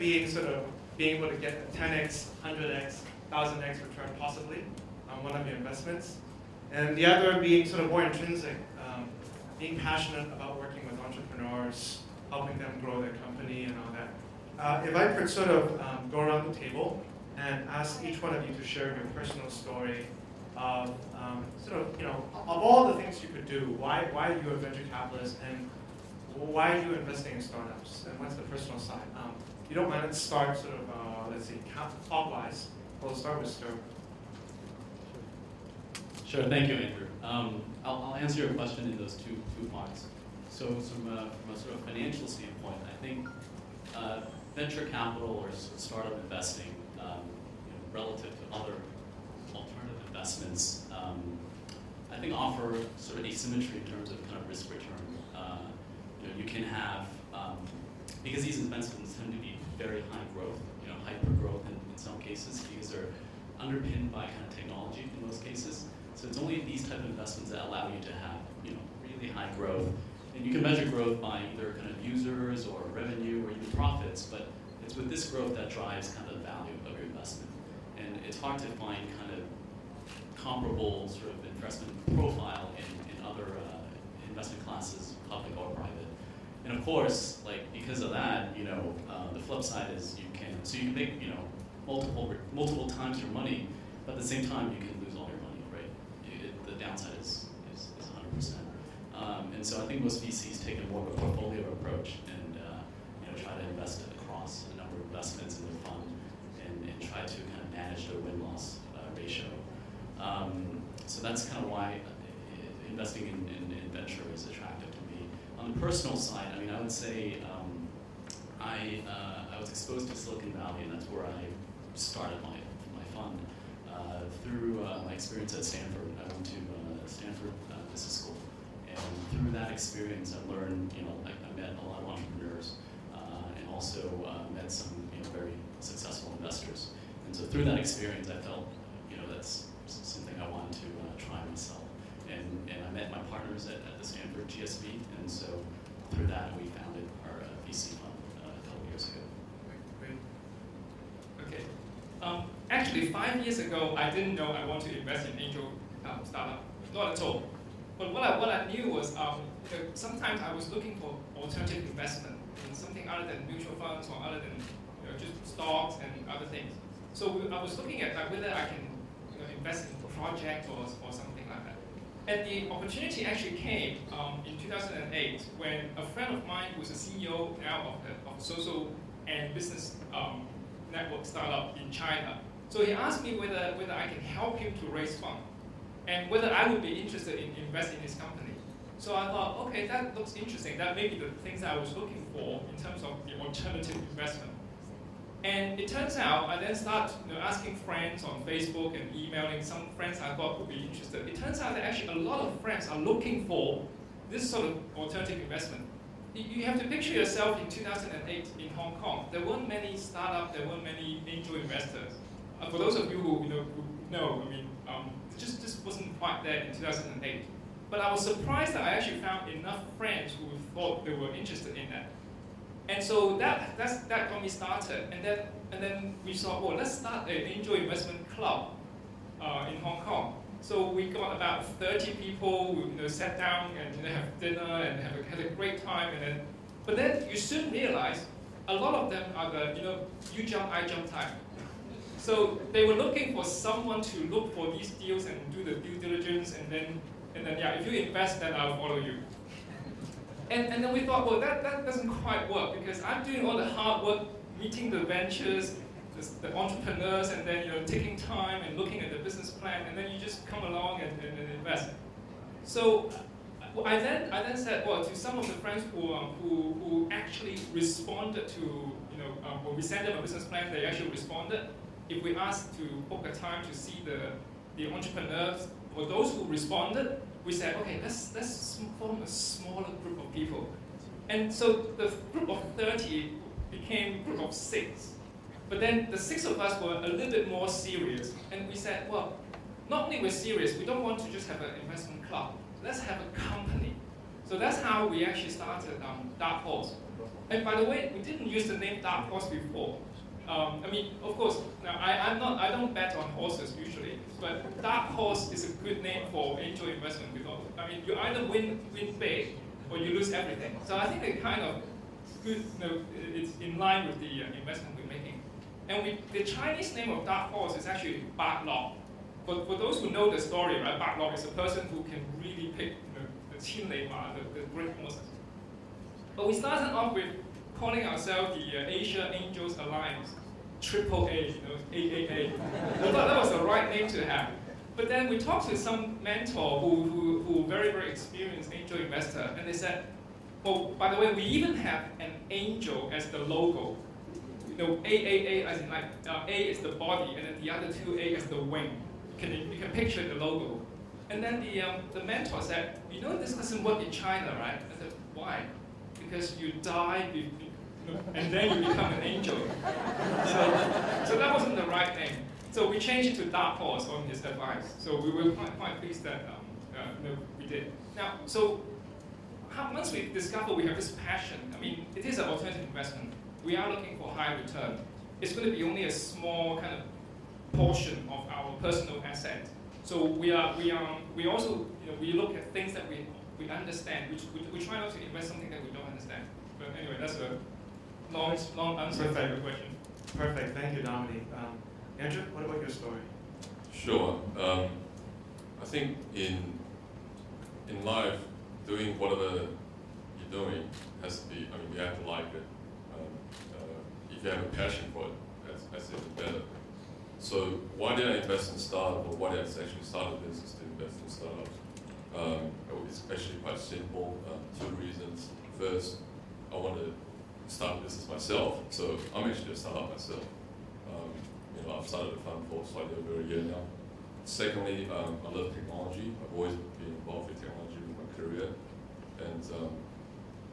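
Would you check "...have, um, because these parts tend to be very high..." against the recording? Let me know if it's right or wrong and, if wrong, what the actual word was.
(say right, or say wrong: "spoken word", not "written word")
wrong: "investments", not "parts".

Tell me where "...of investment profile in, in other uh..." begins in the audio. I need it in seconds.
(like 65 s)
81 s.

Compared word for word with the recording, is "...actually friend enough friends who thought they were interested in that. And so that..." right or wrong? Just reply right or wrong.
wrong.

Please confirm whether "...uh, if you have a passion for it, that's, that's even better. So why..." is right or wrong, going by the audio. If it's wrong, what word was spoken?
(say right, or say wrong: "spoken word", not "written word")
right.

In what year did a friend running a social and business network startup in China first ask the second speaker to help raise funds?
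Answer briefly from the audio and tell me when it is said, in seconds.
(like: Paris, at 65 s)
2008, at 174 s.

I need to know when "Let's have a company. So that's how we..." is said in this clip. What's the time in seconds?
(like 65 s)
292 s.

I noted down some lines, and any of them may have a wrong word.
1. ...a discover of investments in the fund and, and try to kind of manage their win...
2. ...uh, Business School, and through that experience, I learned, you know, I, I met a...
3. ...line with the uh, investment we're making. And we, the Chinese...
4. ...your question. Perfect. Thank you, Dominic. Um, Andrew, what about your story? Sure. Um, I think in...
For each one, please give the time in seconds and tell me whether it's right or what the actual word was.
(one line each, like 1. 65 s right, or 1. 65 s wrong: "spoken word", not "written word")
1. 104 s wrong: "number", not "discover"
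2. 127 s right
3. 313 s right
4. 389 s right.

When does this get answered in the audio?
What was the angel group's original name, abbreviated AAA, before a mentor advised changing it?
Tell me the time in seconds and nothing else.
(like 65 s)
328 s.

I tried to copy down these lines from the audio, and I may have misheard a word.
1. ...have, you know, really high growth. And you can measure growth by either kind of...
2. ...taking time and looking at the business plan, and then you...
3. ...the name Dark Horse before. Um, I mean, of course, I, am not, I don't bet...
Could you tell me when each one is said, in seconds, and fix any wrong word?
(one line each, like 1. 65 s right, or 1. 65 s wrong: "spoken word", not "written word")
1. 68 s right
2. 257 s right
3. 298 s right.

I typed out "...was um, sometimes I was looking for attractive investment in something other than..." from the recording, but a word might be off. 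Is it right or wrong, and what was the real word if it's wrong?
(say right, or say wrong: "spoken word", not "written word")
wrong: "alternative", not "attractive".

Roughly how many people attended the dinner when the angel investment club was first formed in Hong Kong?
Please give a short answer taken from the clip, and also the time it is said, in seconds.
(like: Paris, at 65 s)
30, at 231 s.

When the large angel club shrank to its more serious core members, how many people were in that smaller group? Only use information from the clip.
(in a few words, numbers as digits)
6.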